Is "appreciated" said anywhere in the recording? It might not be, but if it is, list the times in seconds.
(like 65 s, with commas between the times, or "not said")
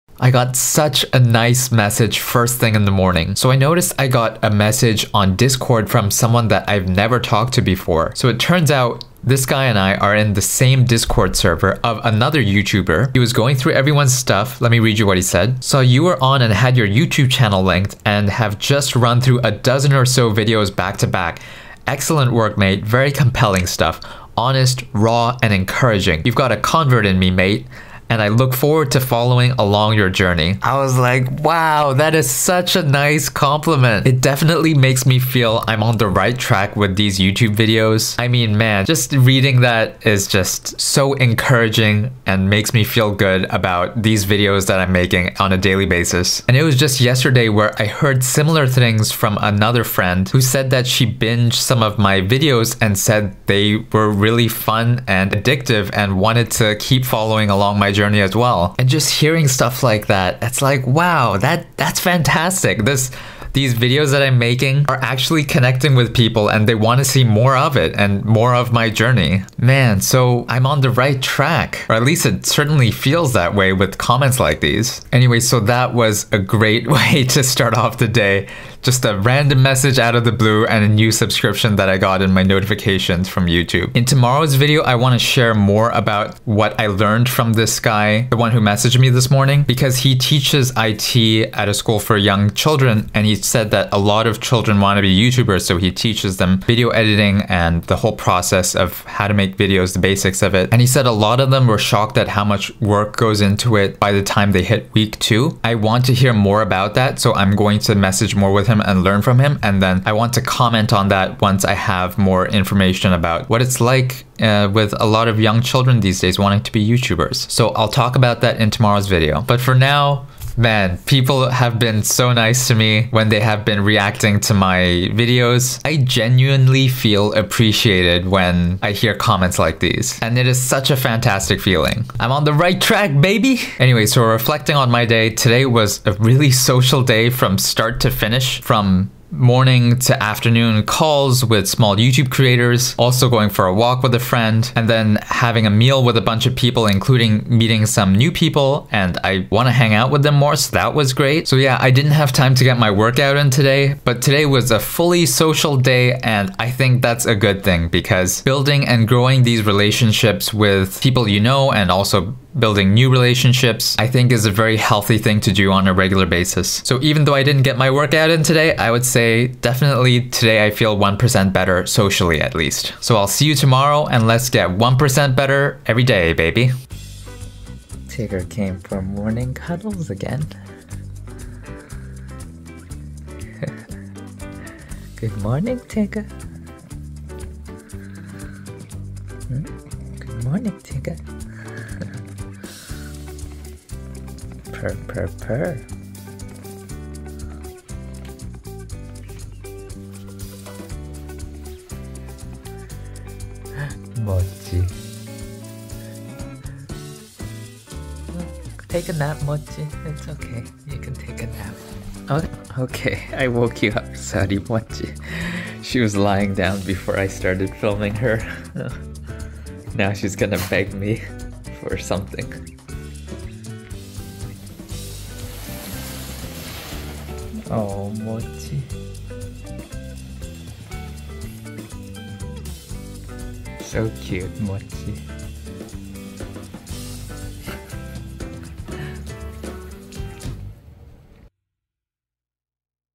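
127 s.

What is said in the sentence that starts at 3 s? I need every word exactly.
So I noticed I got a message on Discord from someone that I've never talked to before.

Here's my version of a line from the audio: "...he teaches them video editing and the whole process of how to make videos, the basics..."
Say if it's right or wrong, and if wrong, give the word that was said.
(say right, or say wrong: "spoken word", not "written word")
right.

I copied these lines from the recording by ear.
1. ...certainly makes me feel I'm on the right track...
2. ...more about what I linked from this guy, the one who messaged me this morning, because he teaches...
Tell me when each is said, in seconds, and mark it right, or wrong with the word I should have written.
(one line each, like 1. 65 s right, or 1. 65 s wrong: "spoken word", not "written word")
1. 34 s wrong: "definitely", not "certainly"
2. 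85 s wrong: "learned", not "linked".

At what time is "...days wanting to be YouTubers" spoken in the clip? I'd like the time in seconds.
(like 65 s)
116 s.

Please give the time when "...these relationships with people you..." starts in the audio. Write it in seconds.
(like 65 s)
159 s.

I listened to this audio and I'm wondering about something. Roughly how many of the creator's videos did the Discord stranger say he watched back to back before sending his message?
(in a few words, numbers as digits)
a dozen.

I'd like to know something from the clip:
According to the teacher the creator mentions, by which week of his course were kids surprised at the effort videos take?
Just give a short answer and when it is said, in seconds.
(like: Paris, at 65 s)
week two, at 104 s.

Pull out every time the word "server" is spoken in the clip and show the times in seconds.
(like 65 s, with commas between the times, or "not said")
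11 s.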